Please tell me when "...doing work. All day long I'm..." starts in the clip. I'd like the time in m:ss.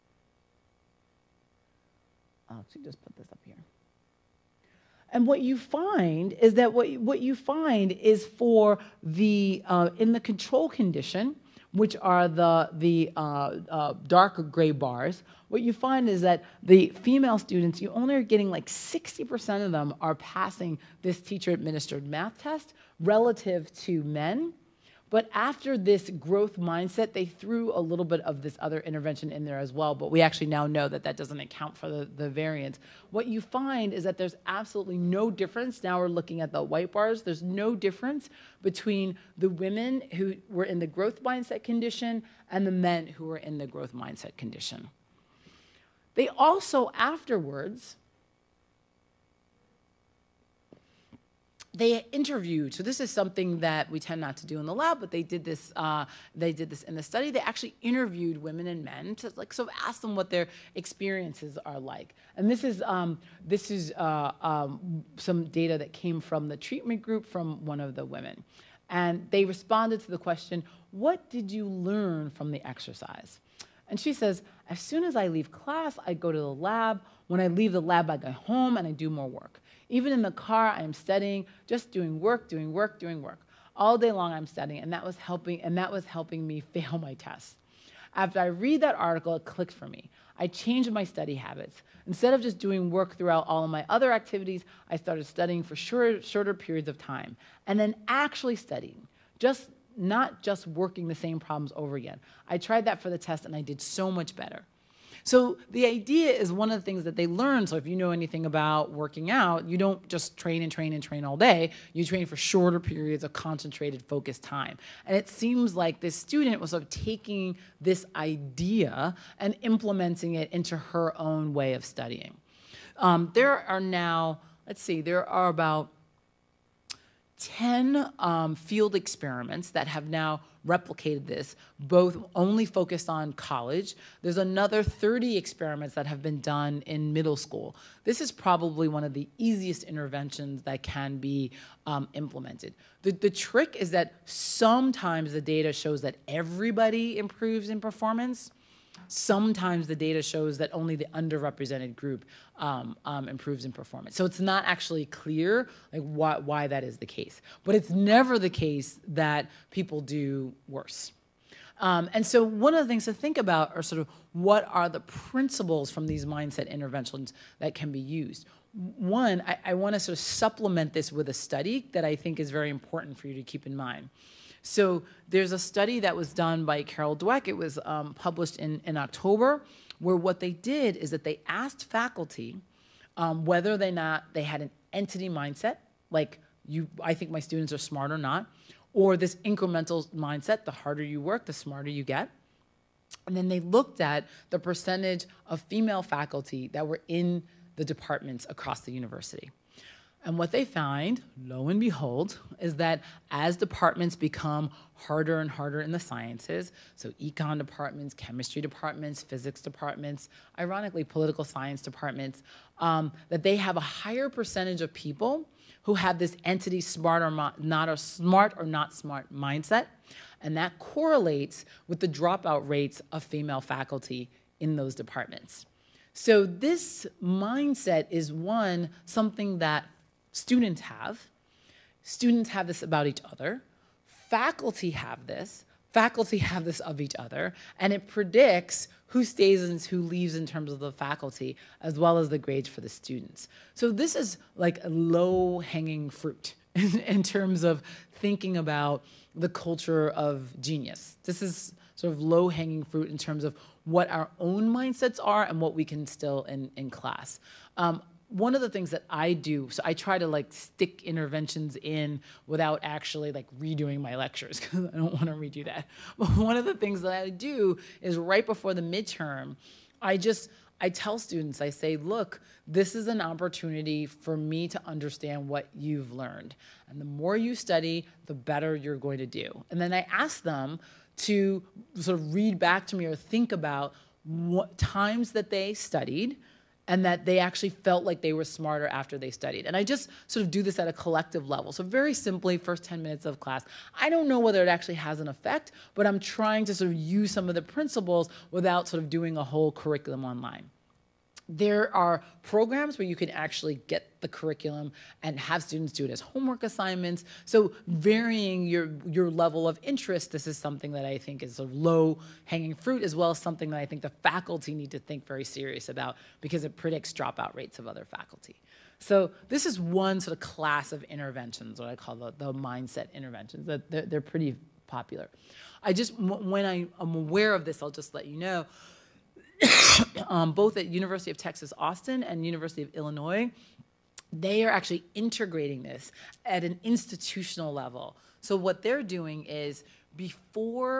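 1:22.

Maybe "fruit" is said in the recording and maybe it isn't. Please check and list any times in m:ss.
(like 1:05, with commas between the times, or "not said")
4:06, 4:12, 5:12.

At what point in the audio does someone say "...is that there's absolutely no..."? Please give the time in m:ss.
0:33.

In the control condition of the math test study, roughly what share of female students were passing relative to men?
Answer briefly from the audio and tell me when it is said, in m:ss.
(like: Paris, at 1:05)
60%, at 0:18.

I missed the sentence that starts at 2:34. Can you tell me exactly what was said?
So it's not actually clear like why, why that is the case.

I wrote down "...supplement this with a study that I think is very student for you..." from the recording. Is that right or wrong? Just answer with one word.
wrong.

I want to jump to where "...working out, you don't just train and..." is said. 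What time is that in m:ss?
1:48.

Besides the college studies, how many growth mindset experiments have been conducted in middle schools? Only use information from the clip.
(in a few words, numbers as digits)
30.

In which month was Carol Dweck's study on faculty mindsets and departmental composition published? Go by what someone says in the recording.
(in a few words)
October.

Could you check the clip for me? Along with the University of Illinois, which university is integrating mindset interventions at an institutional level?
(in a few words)
University of Texas Austin.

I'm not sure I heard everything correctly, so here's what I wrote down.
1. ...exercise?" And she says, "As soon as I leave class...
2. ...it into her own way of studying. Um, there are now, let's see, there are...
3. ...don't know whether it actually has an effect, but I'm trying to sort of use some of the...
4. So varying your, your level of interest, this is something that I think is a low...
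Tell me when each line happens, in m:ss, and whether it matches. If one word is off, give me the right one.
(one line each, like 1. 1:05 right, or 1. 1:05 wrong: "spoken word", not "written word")
1. 1:12 right
2. 2:00 right
3. 4:54 right
4. 5:07 right.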